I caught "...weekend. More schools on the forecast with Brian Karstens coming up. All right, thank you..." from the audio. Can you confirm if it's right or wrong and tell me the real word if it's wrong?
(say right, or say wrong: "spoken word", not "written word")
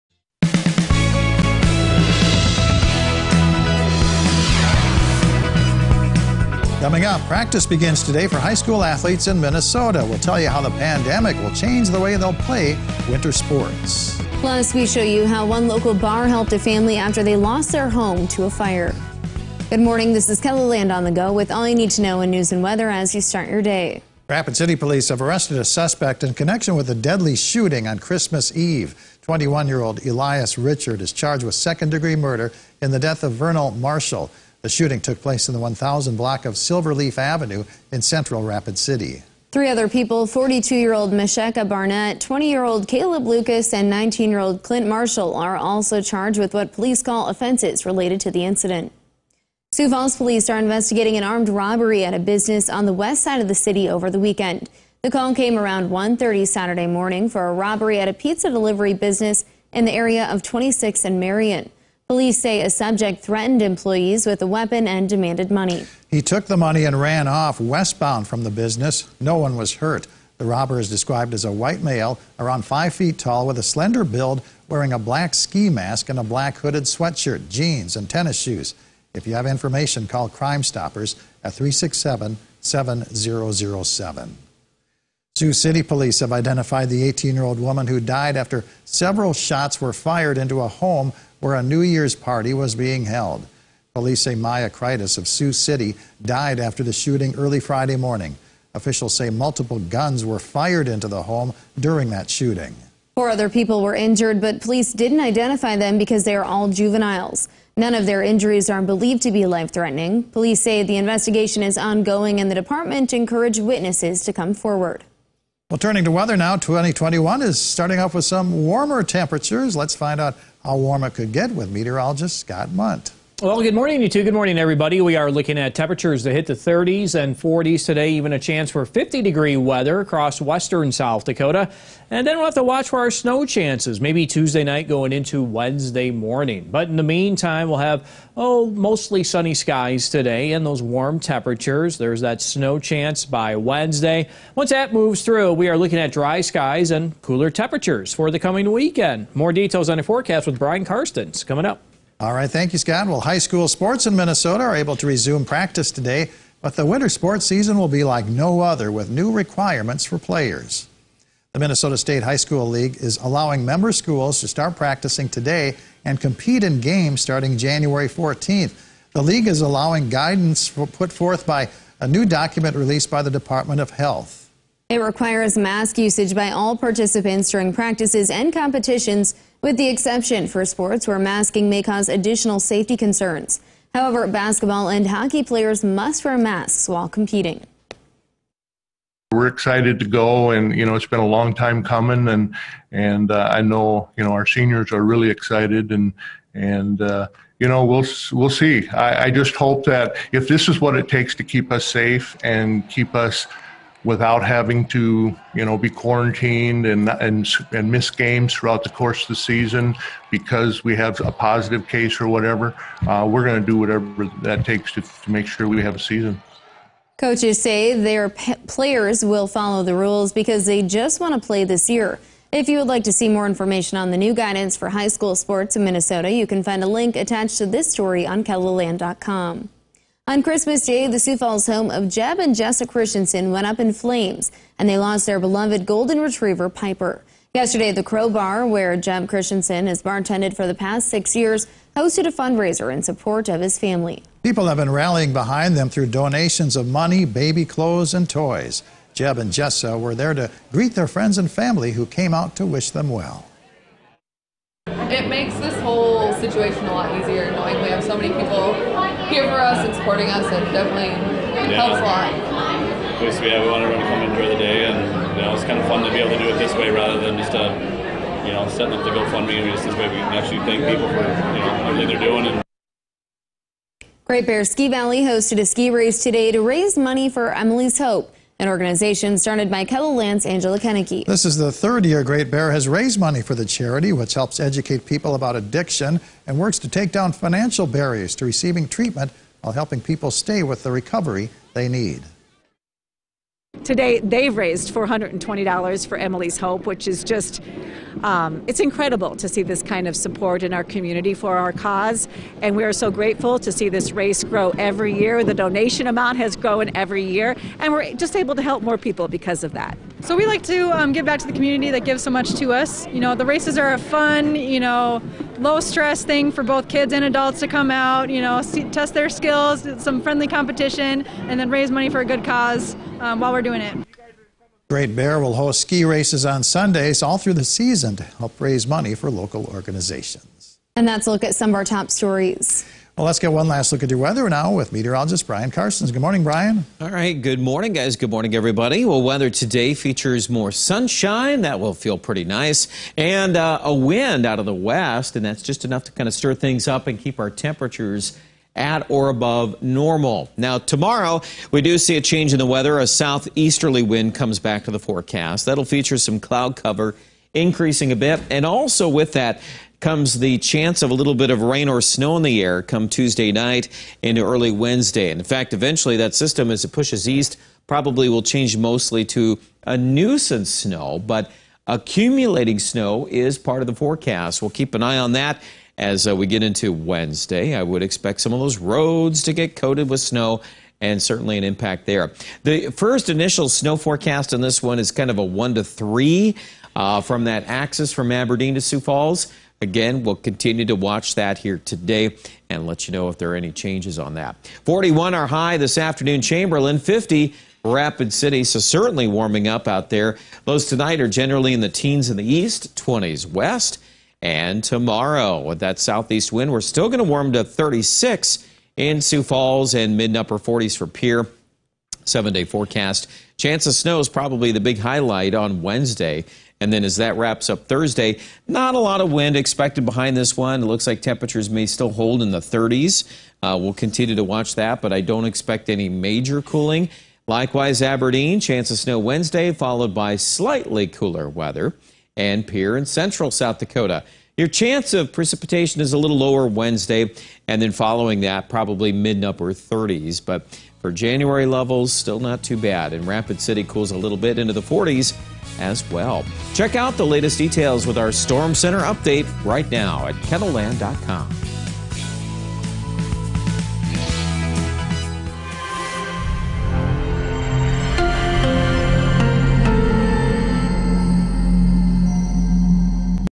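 wrong: "details", not "schools".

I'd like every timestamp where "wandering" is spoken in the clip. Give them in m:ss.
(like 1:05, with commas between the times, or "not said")
not said.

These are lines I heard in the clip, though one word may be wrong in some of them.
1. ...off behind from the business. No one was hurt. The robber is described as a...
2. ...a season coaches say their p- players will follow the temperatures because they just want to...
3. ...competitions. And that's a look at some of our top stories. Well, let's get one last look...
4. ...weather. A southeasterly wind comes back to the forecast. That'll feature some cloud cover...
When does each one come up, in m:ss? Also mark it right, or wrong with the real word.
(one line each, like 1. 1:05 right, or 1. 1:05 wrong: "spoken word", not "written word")
1. 1:07 wrong: "westbound", not "behind"
2. 3:35 wrong: "rules", not "temperatures"
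3. 5:29 wrong: "organizations", not "competitions"
4. 5:52 right.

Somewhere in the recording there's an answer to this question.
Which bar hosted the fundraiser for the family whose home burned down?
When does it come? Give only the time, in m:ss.
3:58.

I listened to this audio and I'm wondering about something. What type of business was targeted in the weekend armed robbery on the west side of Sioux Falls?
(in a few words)
Pizza delivery business.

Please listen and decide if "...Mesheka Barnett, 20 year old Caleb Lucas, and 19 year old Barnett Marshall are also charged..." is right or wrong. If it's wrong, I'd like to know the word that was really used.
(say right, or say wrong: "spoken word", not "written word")
wrong: "Clint", not "Barnett".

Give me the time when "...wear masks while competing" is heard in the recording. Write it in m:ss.
3:06.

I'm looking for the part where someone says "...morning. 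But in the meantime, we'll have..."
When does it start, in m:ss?
2:16.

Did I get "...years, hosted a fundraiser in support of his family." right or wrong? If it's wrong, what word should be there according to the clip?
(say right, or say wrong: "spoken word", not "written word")
right.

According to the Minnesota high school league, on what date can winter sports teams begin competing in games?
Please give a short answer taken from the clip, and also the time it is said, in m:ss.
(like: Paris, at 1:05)
January 14th, at 2:47.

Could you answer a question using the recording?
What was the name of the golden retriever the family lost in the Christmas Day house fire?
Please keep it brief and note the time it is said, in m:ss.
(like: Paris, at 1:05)
Piper, at 3:56.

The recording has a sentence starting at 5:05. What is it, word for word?
The donation amount has grown every year, and we're just able to help more people because of that.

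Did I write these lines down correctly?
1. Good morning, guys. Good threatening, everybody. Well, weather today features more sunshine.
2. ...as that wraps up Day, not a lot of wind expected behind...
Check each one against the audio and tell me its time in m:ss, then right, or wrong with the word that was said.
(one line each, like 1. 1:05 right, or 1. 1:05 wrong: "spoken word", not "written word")
1. 5:37 wrong: "morning", not "threatening"
2. 6:57 wrong: "Thursday", not "Day".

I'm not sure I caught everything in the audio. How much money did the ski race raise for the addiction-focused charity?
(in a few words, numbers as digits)
$420.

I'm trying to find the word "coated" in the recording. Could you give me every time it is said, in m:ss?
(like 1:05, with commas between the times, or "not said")
6:19.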